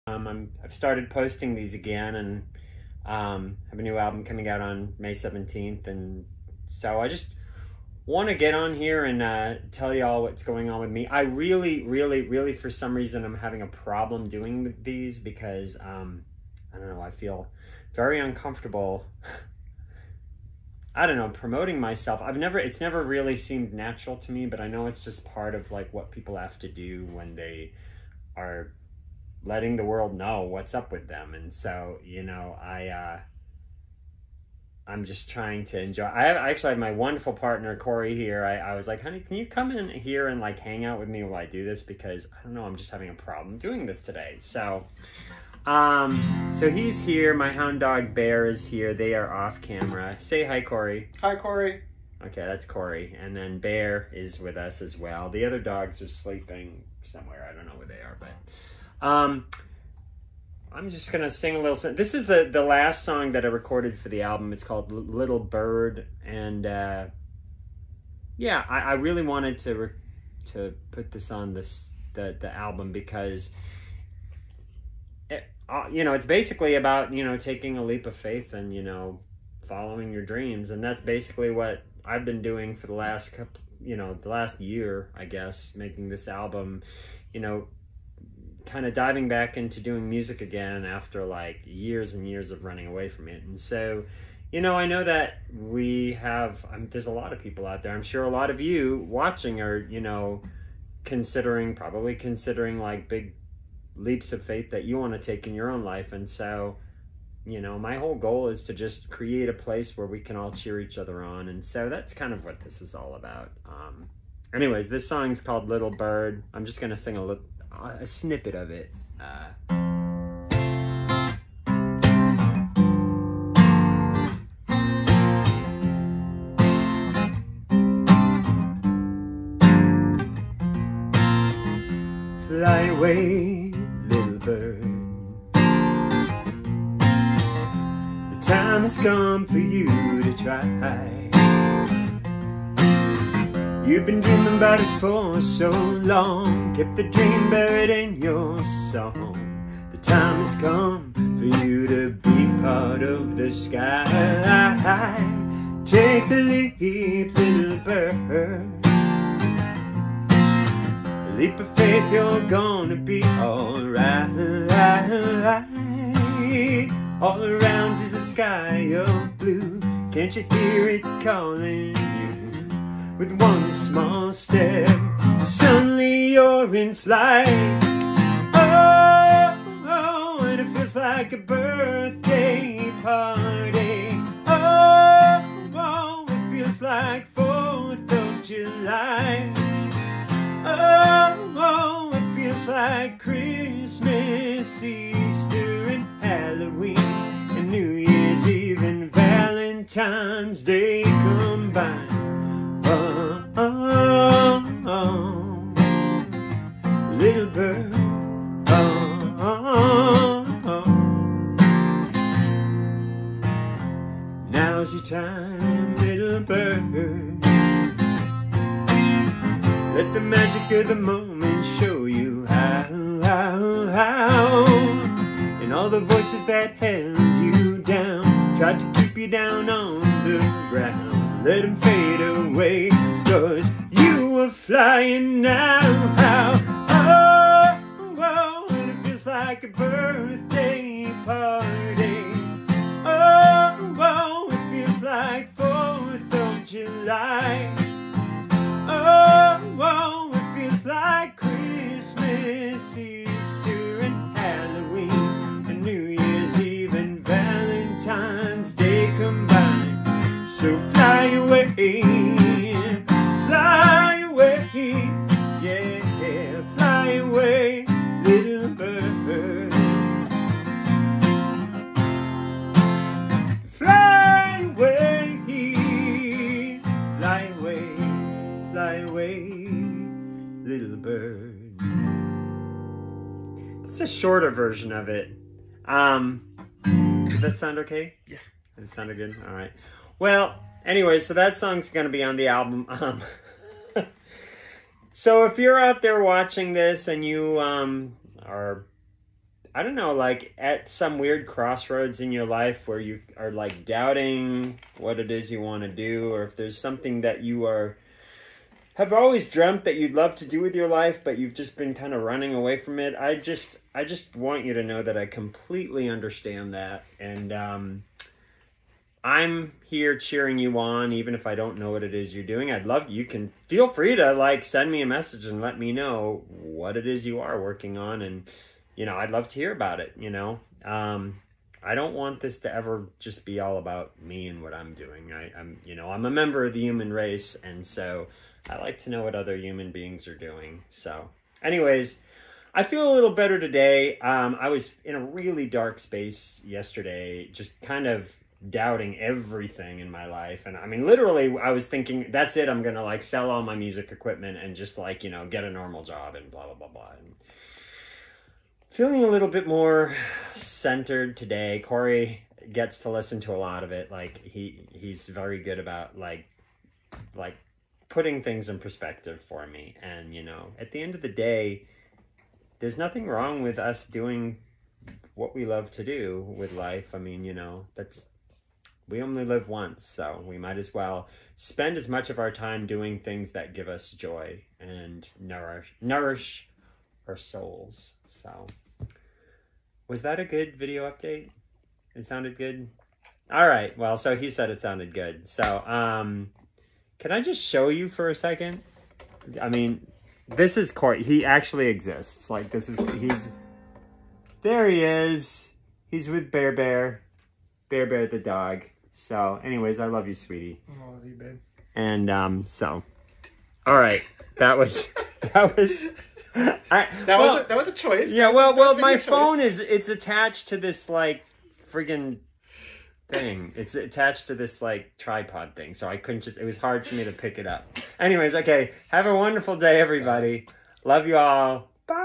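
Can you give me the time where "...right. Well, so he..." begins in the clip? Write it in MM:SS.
06:33.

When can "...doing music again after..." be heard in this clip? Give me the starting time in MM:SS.
01:29.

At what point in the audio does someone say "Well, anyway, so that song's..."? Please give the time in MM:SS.
04:50.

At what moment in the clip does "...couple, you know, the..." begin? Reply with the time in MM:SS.
01:23.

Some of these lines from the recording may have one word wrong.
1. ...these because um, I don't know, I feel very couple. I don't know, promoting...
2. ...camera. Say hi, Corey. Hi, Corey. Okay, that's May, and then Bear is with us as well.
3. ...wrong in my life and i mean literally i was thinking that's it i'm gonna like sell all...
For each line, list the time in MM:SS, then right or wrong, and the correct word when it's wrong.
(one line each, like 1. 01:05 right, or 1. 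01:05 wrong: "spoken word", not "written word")
1. 00:14 wrong: "uncomfortable", not "couple"
2. 00:49 wrong: "Corey", not "May"
3. 05:49 wrong: "everything", not "wrong".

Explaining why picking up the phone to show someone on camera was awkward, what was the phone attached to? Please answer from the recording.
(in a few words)
tripod.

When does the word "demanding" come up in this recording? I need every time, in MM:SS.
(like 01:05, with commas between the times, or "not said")
not said.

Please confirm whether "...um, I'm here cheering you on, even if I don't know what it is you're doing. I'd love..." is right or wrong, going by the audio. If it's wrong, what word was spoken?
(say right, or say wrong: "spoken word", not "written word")
right.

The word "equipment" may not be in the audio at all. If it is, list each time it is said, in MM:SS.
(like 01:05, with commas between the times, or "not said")
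05:54.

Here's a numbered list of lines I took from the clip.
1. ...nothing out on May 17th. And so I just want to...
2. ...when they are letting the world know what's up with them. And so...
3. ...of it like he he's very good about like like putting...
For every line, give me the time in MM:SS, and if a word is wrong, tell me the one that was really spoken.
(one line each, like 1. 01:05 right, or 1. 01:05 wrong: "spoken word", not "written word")
1. 00:04 wrong: "coming", not "nothing"
2. 00:27 right
3. 06:03 right.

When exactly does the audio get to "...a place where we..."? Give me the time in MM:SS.
01:49.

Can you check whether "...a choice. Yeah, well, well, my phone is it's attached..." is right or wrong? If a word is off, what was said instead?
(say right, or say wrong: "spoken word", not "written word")
right.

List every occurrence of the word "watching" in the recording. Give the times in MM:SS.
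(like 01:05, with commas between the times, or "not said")
01:39, 04:56.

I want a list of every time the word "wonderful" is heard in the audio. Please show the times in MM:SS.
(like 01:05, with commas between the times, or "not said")
00:36, 07:09.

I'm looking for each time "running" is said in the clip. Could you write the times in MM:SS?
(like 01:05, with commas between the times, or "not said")
01:32, 05:12.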